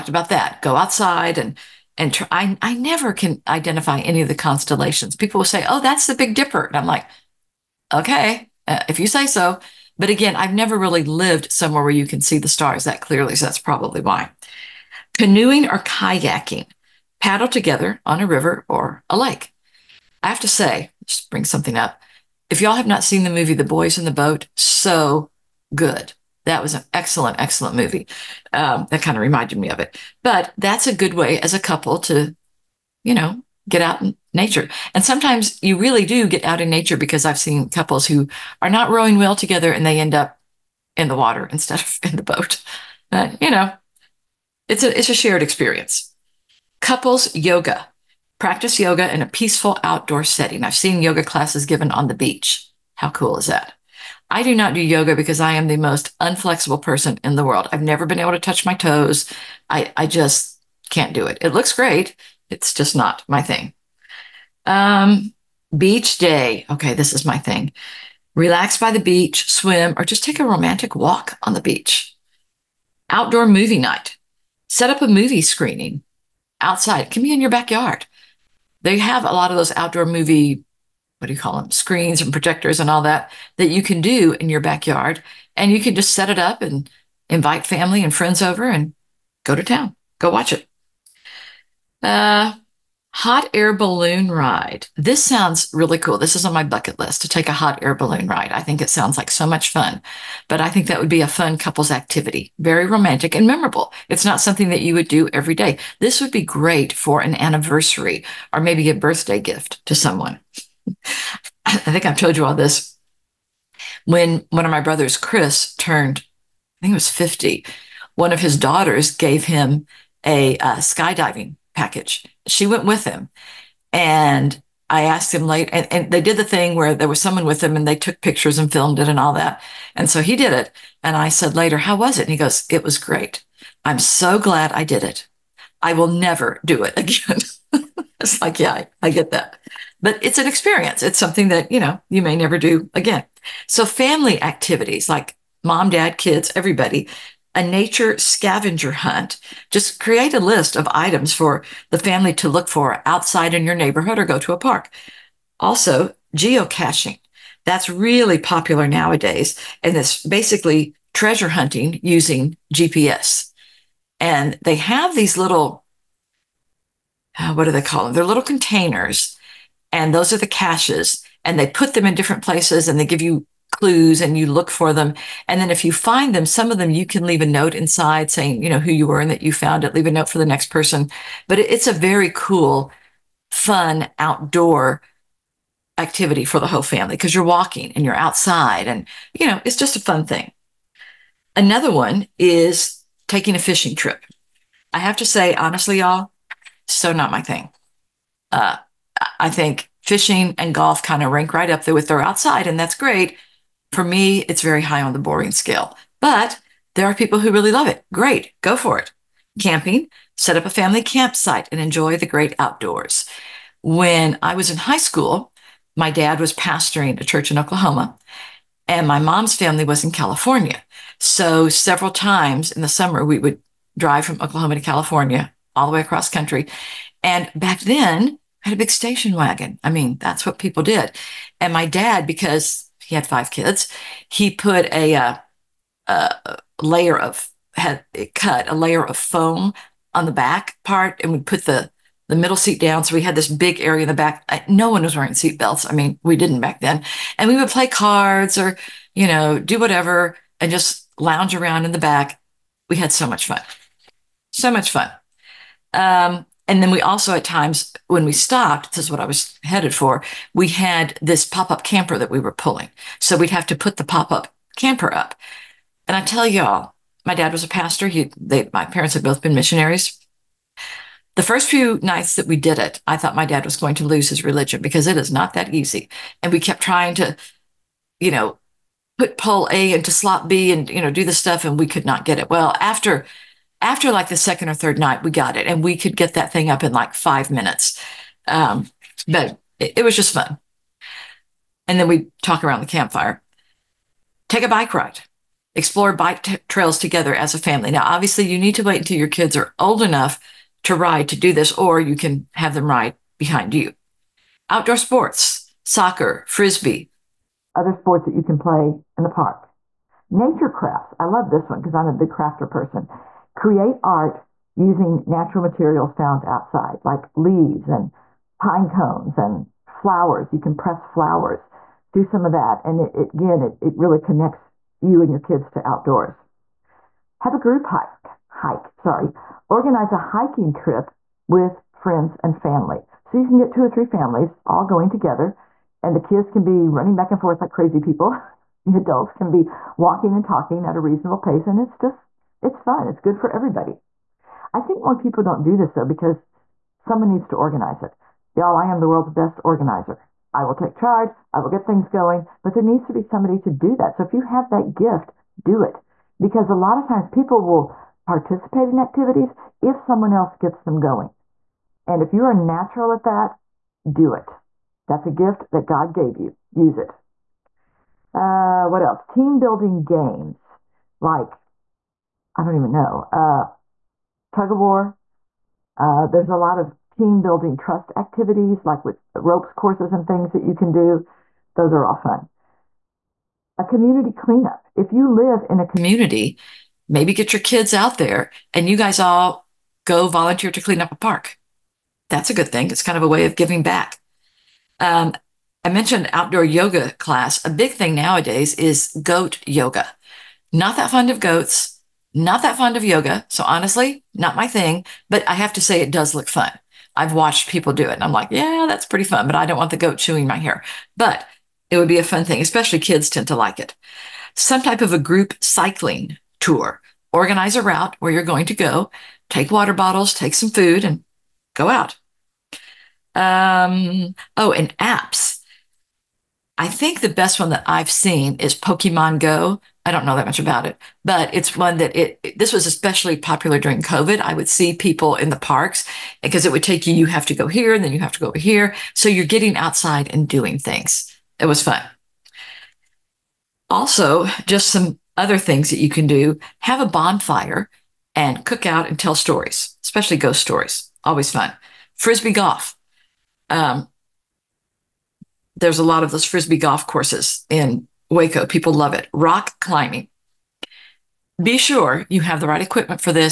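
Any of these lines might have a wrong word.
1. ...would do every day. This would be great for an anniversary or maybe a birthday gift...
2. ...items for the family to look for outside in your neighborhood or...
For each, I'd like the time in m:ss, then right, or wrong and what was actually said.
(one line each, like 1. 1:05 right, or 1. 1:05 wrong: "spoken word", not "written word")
1. 1:44 right
2. 2:30 right.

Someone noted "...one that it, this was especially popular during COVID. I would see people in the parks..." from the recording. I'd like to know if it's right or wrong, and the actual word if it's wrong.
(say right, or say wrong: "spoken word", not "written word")
right.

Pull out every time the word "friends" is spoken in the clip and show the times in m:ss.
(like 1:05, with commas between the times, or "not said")
1:28, 5:31.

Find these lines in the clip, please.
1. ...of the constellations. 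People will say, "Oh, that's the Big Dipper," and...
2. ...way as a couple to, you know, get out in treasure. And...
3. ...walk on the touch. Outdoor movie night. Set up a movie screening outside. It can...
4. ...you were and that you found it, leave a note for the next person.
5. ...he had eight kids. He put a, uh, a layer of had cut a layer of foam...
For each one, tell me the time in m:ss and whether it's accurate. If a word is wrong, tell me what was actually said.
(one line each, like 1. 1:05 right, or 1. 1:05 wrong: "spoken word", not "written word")
1. 0:04 right
2. 0:31 wrong: "nature", not "treasure"
3. 1:10 wrong: "beach", not "touch"
4. 2:58 right
5. 3:53 wrong: "five", not "eight".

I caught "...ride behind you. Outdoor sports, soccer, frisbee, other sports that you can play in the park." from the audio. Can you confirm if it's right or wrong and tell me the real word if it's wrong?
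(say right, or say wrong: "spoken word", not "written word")
right.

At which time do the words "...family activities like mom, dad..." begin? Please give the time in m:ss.
2:23.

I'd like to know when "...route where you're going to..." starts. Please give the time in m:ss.
6:57.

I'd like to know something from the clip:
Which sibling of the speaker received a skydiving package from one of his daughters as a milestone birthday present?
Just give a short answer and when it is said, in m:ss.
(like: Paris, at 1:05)
Chris, at 1:55.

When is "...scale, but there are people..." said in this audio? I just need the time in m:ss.
3:25.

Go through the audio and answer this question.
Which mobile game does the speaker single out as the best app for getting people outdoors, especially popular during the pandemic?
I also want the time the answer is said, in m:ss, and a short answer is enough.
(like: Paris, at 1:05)
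Pokemon Go, at 7:08.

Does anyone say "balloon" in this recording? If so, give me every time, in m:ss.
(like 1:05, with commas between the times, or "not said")
1:33, 1:37.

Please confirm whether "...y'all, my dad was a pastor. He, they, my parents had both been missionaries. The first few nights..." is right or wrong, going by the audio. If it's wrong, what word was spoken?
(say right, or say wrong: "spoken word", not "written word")
right.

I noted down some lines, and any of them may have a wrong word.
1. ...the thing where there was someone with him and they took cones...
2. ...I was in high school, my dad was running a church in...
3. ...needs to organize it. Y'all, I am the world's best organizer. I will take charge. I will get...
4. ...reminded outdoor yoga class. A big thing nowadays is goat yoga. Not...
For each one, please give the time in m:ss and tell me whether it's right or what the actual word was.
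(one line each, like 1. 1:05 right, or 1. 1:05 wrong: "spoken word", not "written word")
1. 2:06 wrong: "pictures", not "cones"
2. 3:34 wrong: "pastoring", not "running"
3. 5:47 right
4. 6:35 wrong: "mentioned", not "reminded".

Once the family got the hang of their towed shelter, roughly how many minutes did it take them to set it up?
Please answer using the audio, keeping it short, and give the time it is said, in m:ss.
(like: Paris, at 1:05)
5, at 4:47.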